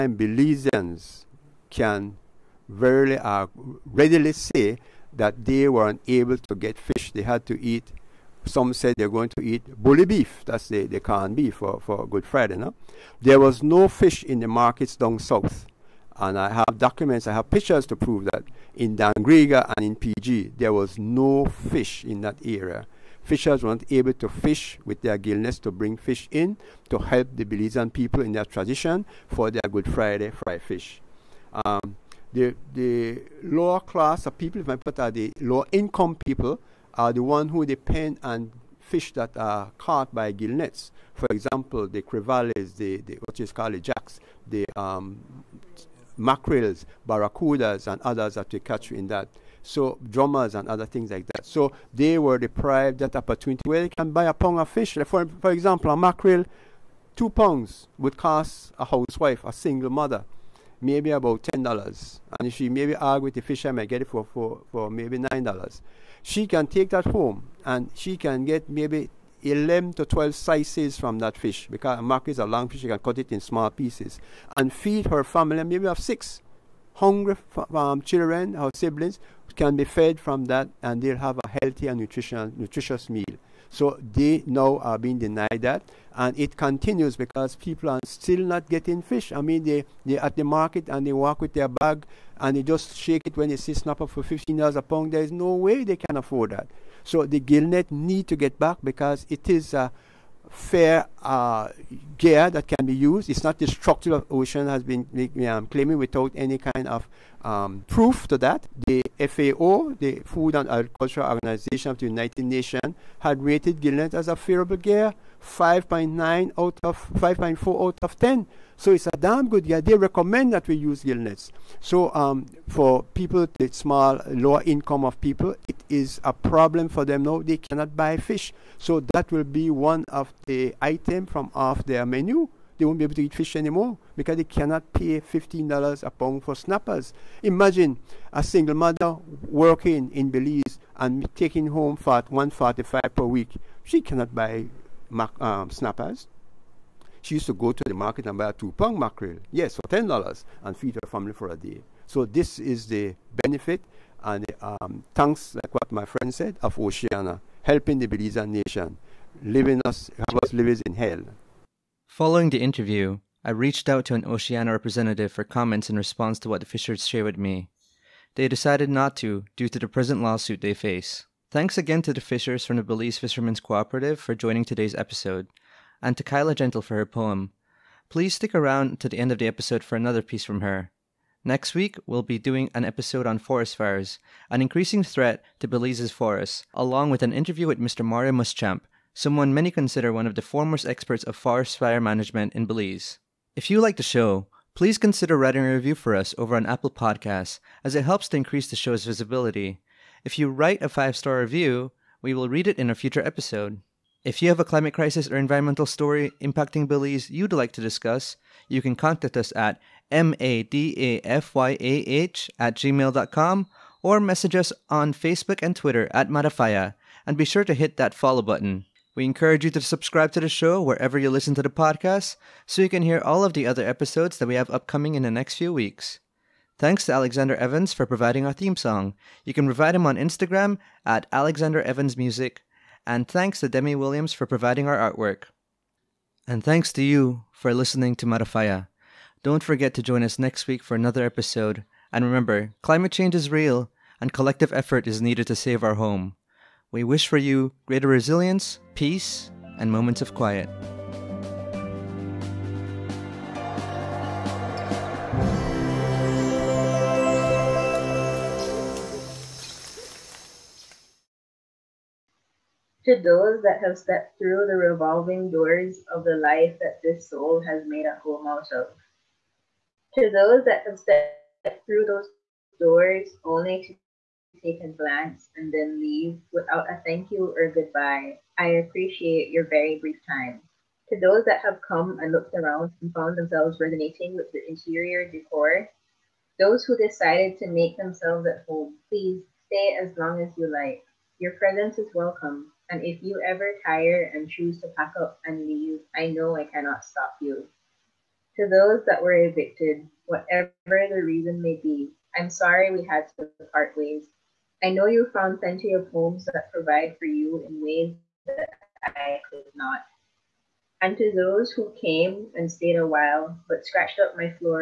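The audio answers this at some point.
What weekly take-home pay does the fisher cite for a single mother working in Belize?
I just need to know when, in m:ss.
2:22.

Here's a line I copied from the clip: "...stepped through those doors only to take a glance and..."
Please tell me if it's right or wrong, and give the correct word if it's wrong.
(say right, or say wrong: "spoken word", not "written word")
right.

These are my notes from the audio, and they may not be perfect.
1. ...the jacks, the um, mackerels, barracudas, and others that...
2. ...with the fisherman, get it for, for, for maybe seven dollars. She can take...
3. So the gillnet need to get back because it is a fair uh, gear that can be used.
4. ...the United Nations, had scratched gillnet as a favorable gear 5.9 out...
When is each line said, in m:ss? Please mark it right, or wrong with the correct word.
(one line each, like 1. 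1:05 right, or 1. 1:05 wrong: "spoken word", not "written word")
1. 0:43 right
2. 1:03 wrong: "nine", not "seven"
3. 1:37 right
4. 1:51 wrong: "rated", not "scratched".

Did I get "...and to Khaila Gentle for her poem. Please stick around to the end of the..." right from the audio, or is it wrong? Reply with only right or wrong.
right.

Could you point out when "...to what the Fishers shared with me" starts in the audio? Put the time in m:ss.
2:46.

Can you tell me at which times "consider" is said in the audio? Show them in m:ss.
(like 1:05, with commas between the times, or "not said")
3:09, 3:14.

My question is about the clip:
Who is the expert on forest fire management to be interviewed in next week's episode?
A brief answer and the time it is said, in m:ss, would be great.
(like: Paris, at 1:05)
Mario Muschamp, at 3:08.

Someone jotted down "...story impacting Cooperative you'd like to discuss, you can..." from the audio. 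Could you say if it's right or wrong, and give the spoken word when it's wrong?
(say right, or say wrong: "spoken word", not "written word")
wrong: "Belize", not "Cooperative".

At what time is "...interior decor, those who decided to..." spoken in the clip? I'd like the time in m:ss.
4:44.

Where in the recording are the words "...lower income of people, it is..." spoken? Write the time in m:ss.
2:04.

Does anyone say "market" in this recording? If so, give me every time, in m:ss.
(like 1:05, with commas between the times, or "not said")
0:14, 1:30, 2:27.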